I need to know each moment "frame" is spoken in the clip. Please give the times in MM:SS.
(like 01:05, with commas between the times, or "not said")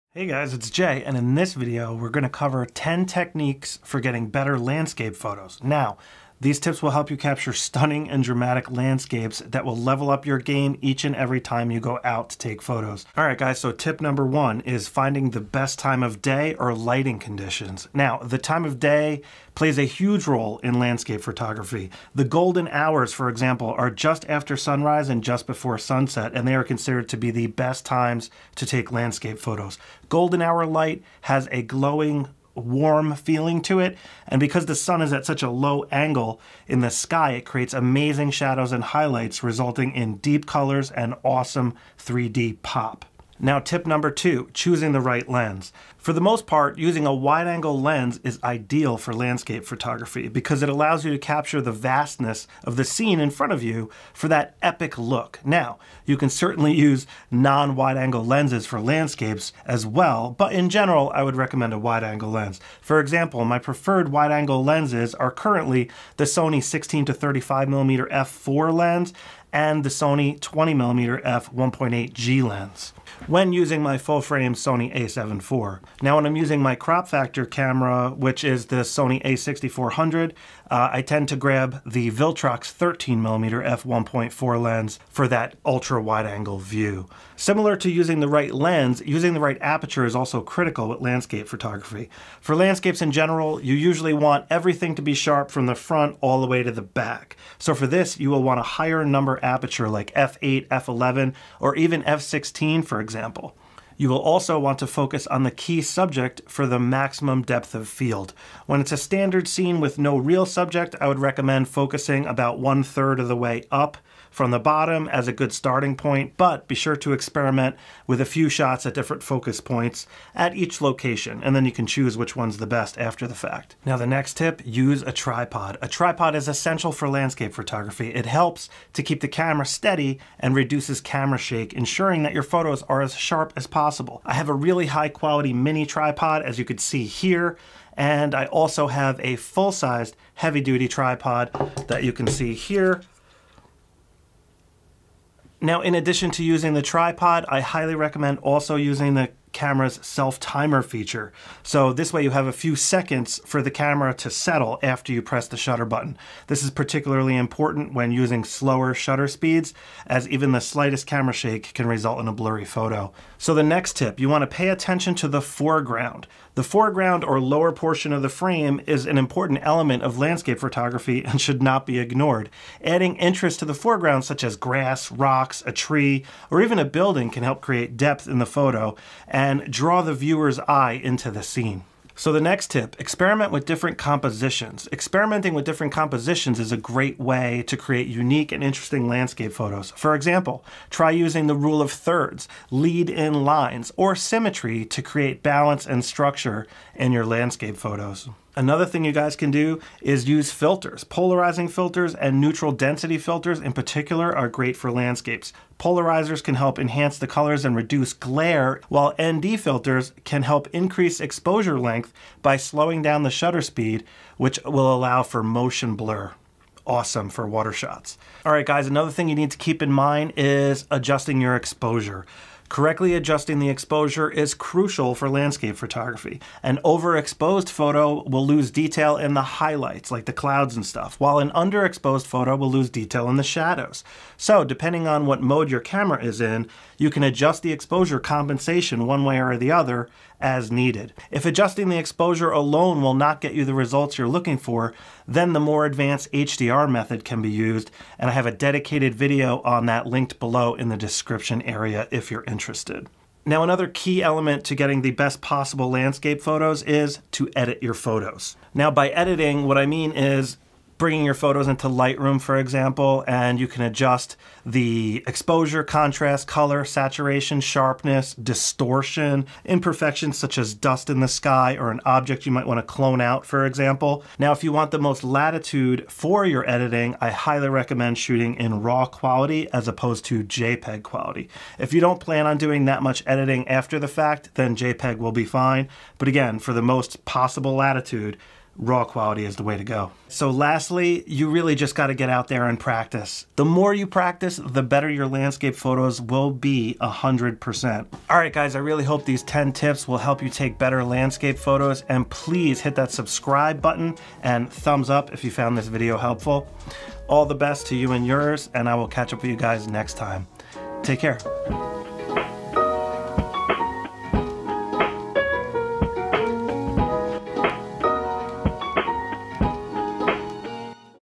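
01:14, 02:48.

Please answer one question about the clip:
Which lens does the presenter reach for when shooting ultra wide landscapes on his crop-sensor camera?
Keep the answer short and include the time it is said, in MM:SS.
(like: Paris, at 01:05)
Viltrox 13mm f1.4, at 01:22.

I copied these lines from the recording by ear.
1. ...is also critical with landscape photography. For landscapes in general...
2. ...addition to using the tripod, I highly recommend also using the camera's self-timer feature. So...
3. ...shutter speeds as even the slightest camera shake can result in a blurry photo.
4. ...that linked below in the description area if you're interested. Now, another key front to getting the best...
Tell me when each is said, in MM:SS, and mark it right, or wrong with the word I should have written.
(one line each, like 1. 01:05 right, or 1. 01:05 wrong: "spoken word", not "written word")
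1. 01:30 right
2. 02:25 right
3. 02:38 right
4. 04:09 wrong: "element", not "front".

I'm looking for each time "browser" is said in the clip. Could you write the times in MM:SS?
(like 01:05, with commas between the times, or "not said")
not said.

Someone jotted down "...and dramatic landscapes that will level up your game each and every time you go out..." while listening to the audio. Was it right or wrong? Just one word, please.
right.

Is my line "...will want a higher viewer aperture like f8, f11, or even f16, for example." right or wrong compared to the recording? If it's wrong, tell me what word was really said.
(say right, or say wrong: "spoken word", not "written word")
wrong: "number", not "viewer".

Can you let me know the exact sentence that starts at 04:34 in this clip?
Now, if you want the most latitude for your editing, I highly recommend shooting in RAW quality as opposed to JPEG quality.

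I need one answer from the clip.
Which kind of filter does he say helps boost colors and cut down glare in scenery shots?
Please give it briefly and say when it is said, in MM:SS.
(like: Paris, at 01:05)
Polarizing filters, at 03:21.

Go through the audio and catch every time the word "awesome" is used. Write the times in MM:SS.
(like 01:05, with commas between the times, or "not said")
00:41, 03:36.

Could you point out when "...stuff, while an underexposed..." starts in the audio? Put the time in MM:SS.
03:50.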